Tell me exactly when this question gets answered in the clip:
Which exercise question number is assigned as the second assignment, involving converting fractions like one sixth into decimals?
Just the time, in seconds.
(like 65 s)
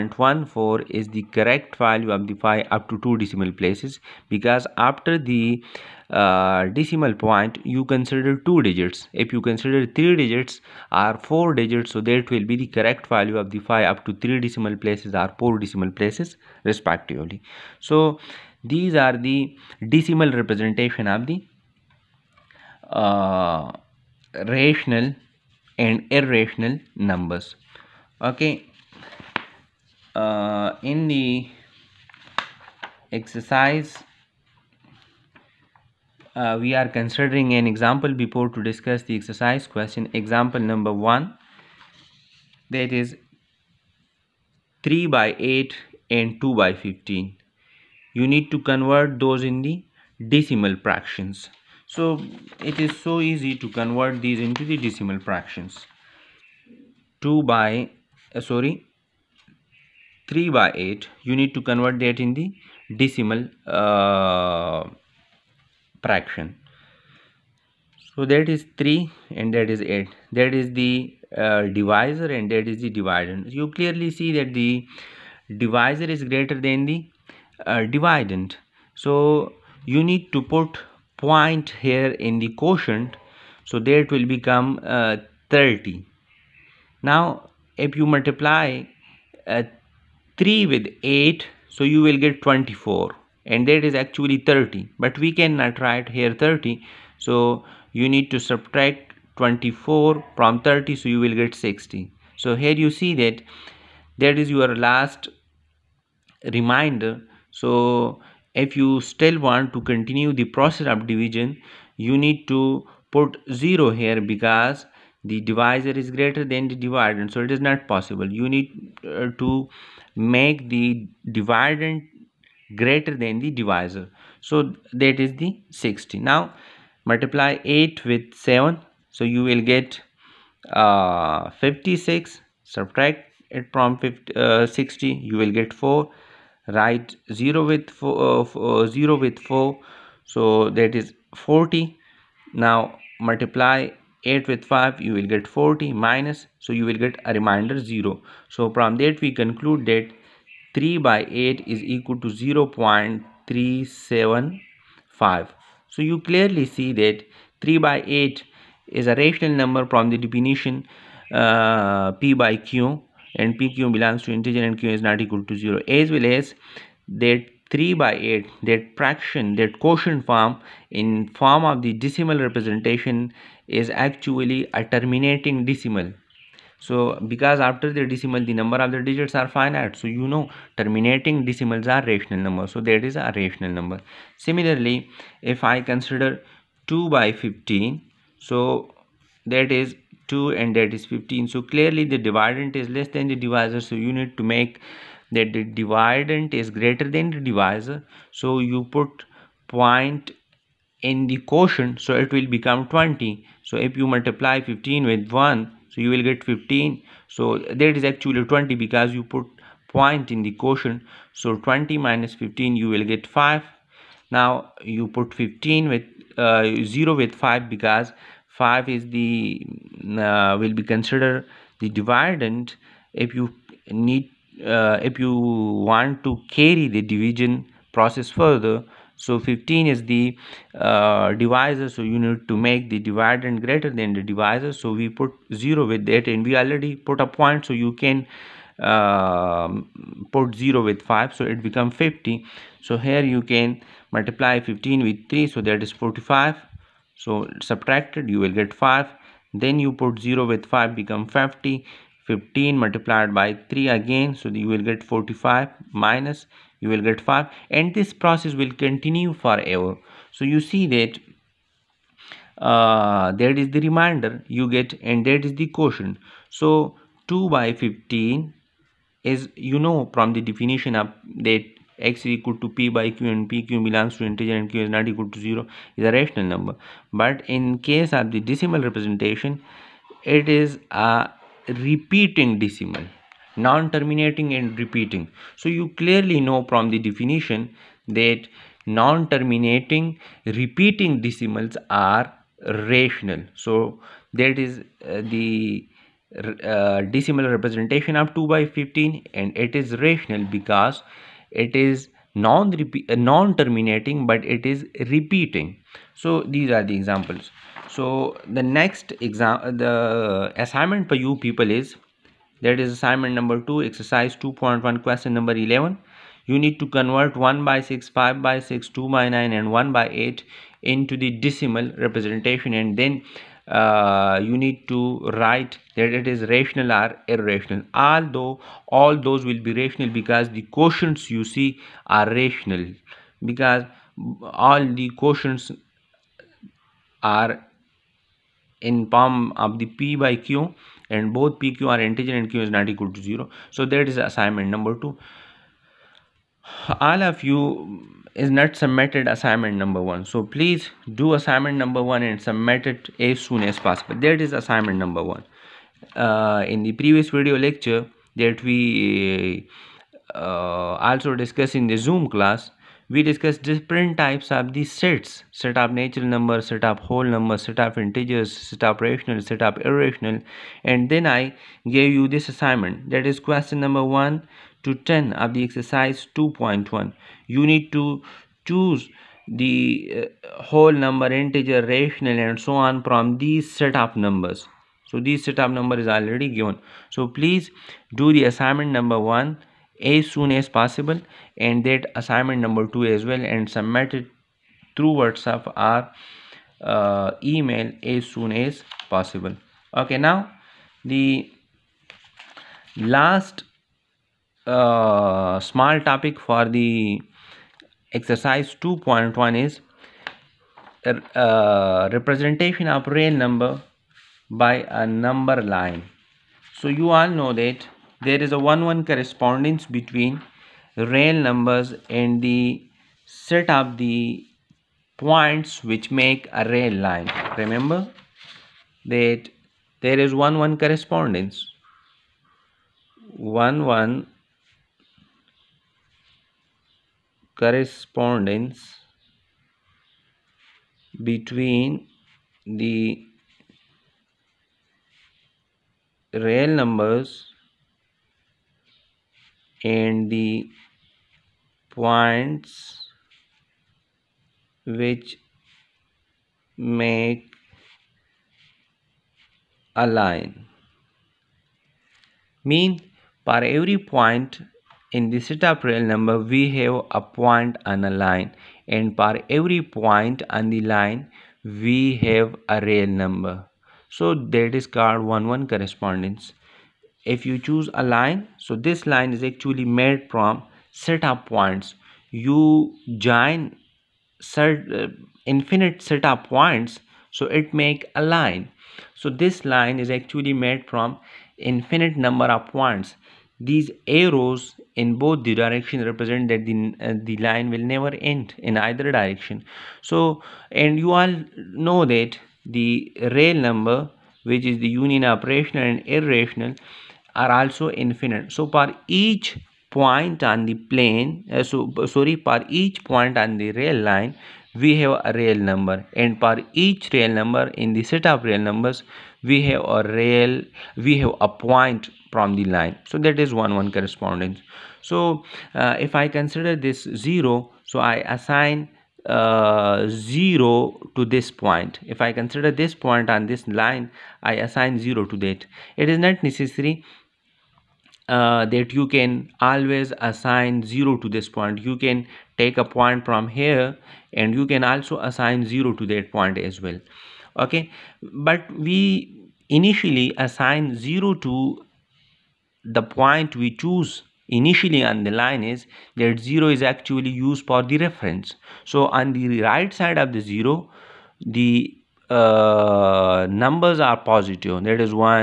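315 s.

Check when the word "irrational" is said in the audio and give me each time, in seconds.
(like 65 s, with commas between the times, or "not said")
26 s, 327 s, 369 s, 506 s.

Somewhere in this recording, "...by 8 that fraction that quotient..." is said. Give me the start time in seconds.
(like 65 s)
168 s.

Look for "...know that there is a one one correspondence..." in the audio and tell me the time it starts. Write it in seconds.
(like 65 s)
417 s.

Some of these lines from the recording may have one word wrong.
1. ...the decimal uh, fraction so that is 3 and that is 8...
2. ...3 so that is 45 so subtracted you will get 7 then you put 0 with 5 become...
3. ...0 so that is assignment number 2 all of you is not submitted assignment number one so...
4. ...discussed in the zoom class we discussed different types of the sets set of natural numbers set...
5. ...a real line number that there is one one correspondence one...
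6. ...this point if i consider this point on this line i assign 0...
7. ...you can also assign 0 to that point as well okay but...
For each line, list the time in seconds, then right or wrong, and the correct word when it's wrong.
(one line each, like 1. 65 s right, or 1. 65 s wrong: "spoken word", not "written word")
1. 62 s right
2. 245 s wrong: "5", not "7"
3. 343 s right
4. 361 s right
5. 426 s wrong: "remember", not "number"
6. 531 s right
7. 544 s right.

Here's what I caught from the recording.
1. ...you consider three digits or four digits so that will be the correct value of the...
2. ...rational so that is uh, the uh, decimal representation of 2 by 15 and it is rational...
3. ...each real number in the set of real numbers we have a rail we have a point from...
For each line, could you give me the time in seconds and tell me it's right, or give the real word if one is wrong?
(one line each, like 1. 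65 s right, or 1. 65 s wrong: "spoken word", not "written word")
1. 9 s right
2. 292 s right
3. 516 s right.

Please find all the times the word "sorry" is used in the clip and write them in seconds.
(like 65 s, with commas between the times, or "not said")
58 s, 512 s.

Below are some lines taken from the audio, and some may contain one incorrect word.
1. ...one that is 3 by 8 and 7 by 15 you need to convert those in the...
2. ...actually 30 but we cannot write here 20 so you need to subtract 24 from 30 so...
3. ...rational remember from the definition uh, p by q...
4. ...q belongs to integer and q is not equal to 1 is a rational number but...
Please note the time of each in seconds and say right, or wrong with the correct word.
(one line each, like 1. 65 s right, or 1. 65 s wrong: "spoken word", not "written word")
1. 40 s wrong: "2", not "7"
2. 93 s wrong: "30", not "20"
3. 159 s wrong: "number", not "remember"
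4. 273 s wrong: "0", not "1".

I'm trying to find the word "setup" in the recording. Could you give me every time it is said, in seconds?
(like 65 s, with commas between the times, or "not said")
465 s, 480 s, 486 s.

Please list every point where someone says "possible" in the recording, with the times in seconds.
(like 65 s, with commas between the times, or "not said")
117 s, 353 s, 390 s, 399 s.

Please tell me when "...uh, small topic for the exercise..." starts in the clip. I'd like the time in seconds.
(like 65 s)
404 s.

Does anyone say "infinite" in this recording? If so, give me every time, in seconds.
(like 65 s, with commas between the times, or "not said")
485 s, 491 s, 507 s.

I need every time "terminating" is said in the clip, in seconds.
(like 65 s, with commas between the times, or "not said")
174 s, 180 s, 283 s, 288 s, 303 s.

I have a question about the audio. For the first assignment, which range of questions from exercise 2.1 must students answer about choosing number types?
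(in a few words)
1 to 10.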